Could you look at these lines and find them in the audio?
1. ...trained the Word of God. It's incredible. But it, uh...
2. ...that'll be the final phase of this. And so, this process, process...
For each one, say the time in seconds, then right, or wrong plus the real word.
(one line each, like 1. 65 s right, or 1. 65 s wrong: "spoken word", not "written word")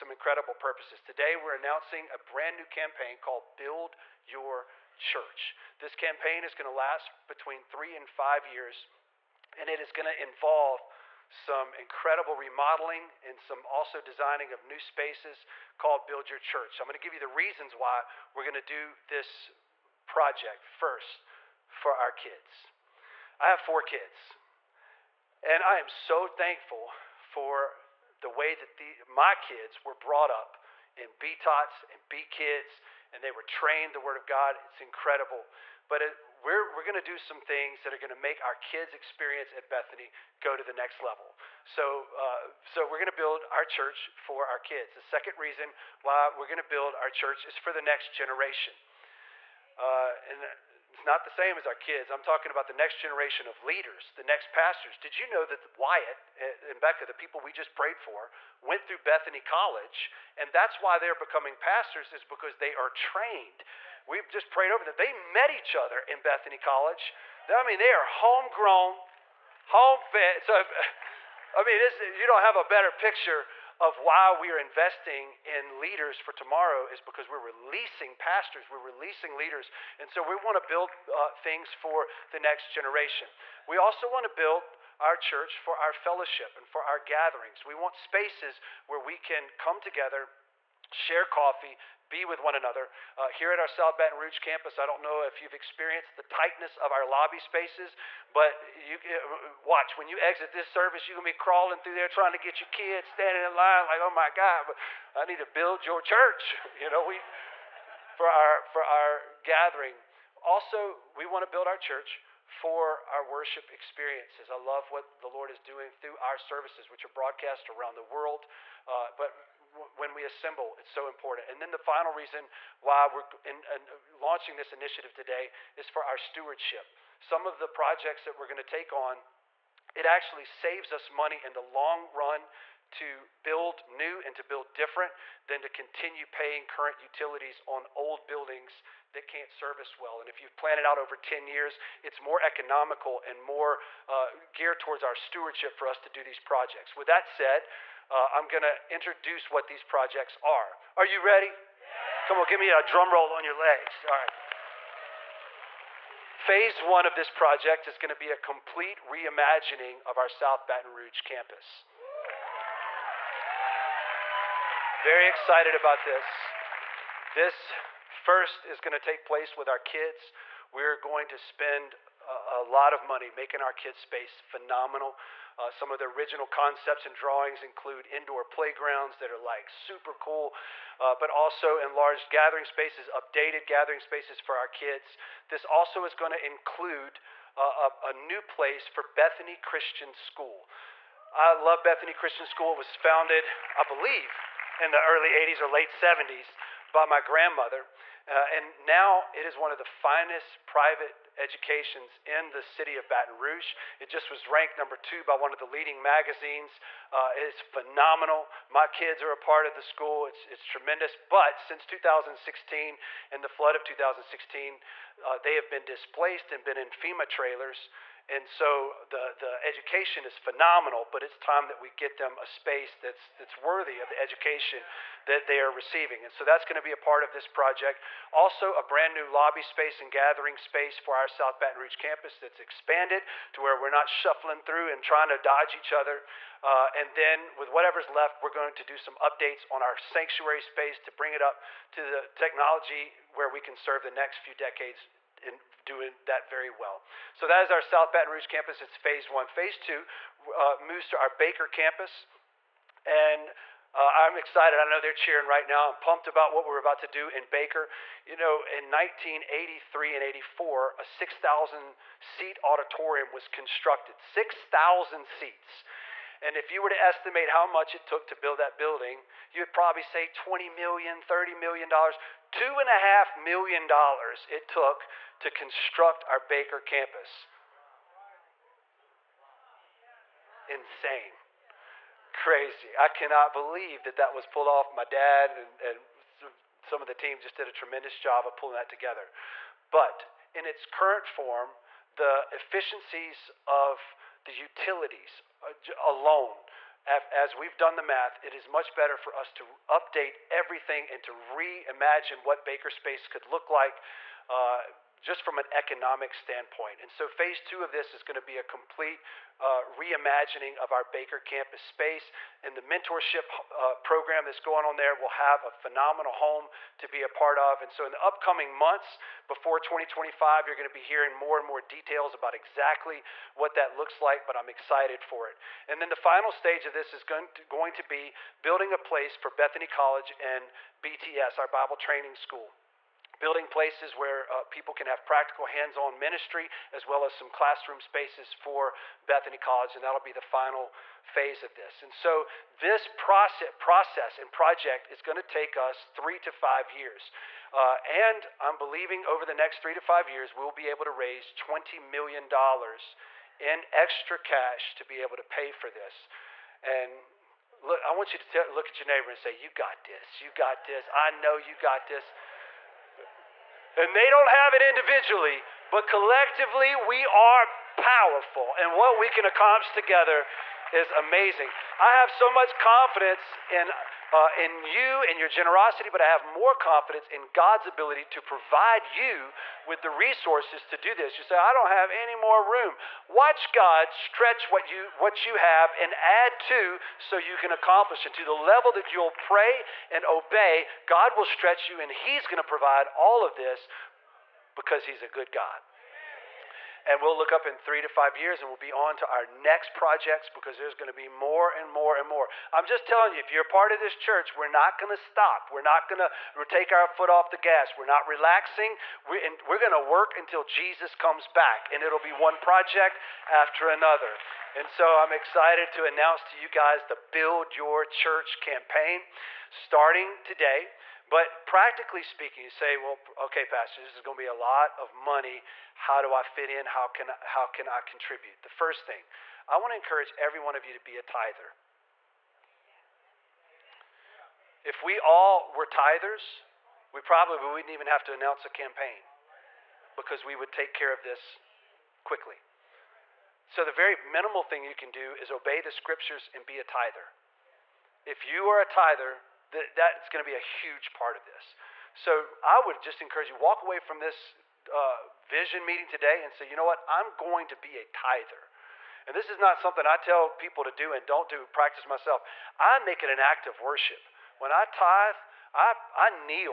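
1. 33 s right
2. 340 s right.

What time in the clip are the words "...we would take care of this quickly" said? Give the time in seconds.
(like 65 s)
440 s.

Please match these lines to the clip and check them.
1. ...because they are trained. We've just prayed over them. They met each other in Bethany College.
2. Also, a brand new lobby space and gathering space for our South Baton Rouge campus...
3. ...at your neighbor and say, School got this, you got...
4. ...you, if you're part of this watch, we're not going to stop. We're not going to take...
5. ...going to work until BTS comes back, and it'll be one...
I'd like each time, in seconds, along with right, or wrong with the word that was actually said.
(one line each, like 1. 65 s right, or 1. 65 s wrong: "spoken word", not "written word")
1. 62 s right
2. 228 s right
3. 358 s wrong: "You", not "School"
4. 403 s wrong: "church", not "watch"
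5. 409 s wrong: "Jesus", not "BTS".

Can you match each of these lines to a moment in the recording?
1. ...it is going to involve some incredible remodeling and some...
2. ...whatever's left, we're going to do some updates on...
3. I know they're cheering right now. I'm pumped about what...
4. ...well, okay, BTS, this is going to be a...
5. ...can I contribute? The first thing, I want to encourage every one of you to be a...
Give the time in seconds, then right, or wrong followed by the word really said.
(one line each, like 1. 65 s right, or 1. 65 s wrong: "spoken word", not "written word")
1. 9 s right
2. 237 s right
3. 254 s right
4. 422 s wrong: "Pastor", not "BTS"
5. 427 s right.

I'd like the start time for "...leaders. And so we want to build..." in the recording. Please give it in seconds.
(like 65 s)
79 s.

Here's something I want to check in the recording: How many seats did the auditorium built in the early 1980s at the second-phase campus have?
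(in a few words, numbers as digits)
6,000.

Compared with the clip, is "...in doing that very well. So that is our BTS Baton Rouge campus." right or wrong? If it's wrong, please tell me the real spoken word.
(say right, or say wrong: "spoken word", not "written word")
wrong: "South", not "BTS".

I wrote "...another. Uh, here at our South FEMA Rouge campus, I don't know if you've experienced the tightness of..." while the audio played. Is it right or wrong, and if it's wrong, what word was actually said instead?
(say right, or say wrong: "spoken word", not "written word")
wrong: "Baton", not "FEMA".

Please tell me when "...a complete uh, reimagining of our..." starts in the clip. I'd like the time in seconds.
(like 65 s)
308 s.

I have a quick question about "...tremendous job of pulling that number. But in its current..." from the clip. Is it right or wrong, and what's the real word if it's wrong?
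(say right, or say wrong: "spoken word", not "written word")
wrong: "together", not "number".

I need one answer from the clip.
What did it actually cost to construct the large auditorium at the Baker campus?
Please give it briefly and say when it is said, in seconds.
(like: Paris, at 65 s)
$2.5 million, at 272 s.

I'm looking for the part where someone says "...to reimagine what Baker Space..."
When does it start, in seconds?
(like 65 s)
301 s.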